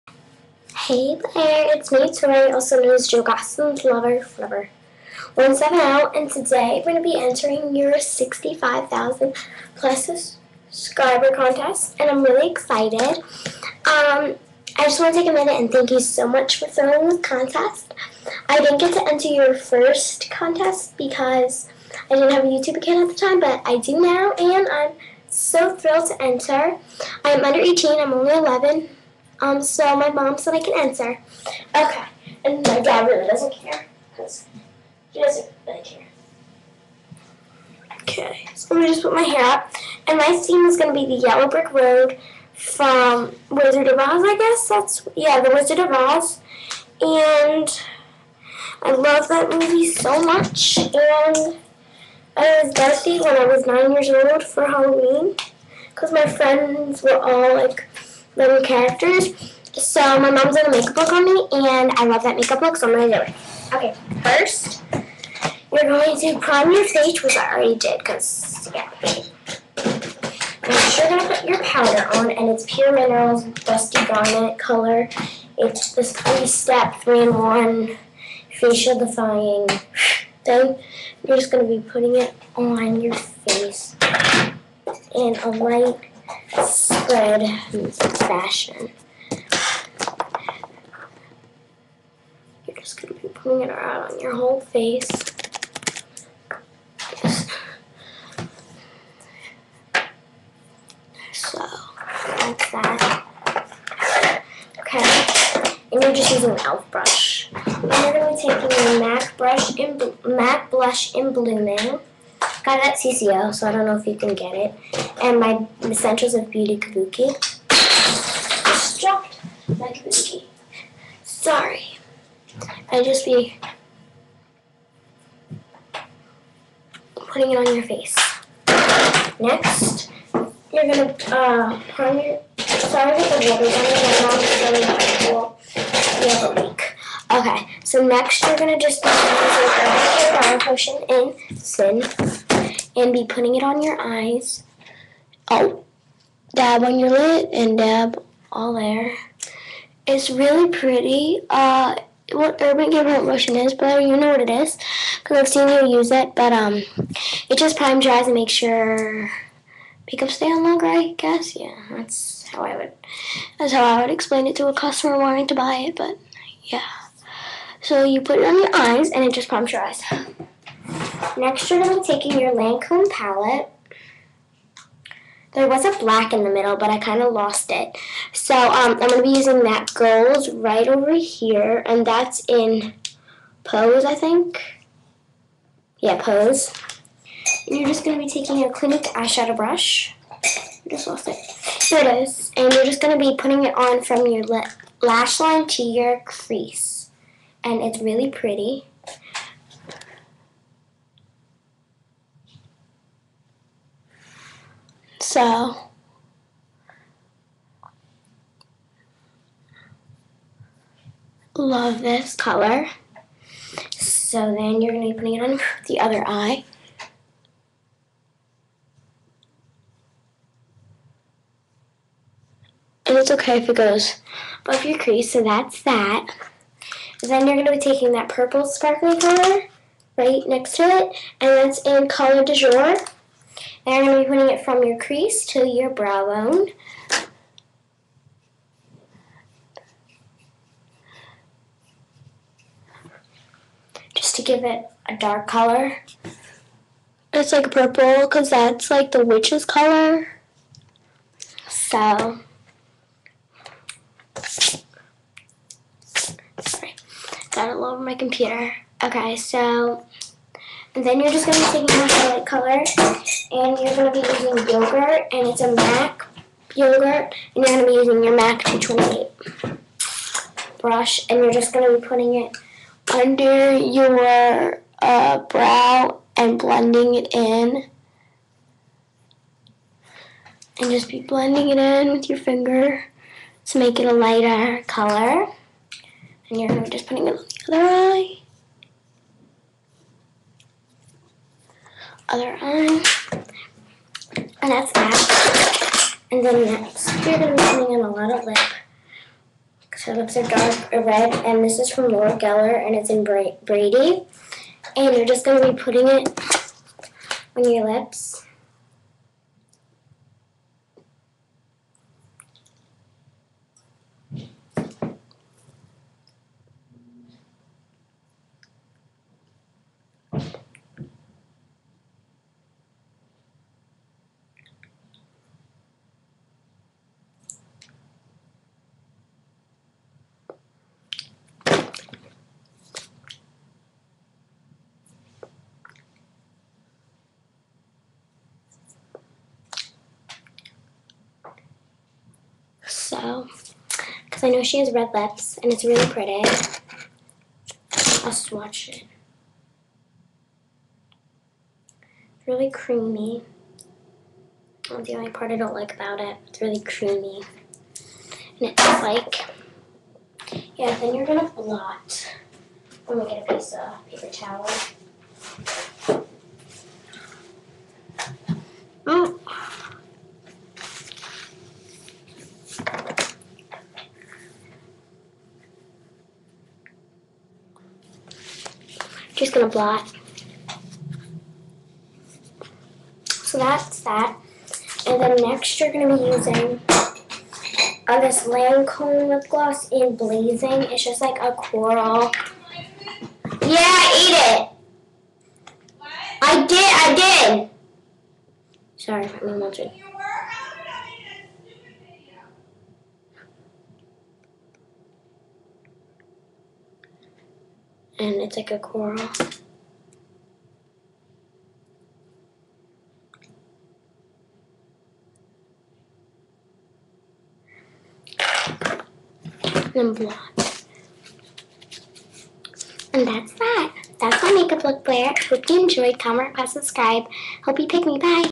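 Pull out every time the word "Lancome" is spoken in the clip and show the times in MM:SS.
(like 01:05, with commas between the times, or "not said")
02:52, 06:28.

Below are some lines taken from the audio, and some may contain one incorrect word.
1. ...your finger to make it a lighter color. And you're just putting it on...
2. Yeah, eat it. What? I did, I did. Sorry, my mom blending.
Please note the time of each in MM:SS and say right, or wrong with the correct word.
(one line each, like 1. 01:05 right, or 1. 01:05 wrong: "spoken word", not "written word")
1. 04:42 right
2. 06:33 wrong: "watching", not "blending".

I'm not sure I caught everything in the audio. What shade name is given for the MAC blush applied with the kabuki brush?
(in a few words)
Blooming.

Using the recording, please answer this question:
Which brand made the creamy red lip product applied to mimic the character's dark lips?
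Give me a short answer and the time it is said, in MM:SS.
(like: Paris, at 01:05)
Laura Geller, at 05:02.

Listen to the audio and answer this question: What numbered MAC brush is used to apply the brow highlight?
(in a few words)
228.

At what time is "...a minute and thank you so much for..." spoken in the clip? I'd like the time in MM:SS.
00:15.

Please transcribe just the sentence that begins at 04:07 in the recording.
It's like purple because that's like the witch's color.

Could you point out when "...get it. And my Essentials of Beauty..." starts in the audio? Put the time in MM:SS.
01:54.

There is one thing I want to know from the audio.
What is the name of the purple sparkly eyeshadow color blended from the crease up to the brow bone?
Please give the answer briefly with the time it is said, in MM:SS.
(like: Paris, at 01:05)
Color de Jour, at 03:52.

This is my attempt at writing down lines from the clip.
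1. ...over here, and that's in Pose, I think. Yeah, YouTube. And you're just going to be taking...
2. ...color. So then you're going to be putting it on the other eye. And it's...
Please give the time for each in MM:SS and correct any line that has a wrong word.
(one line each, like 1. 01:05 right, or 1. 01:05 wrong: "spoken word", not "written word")
1. 03:00 wrong: "Pose", not "YouTube"
2. 03:32 right.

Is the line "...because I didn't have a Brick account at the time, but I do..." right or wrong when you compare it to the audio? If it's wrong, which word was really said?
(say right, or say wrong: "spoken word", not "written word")
wrong: "YouTube", not "Brick".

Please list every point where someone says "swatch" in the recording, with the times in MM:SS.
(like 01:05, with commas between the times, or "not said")
05:48.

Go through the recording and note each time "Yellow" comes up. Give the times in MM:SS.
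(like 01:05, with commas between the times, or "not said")
00:41.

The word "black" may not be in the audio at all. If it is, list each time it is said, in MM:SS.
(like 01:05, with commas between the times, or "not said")
02:55, 07:00.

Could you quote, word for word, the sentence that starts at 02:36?
But um, it just primes your eyes and makes your makeup stay on longer.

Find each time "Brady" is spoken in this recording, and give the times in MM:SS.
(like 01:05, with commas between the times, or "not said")
05:03.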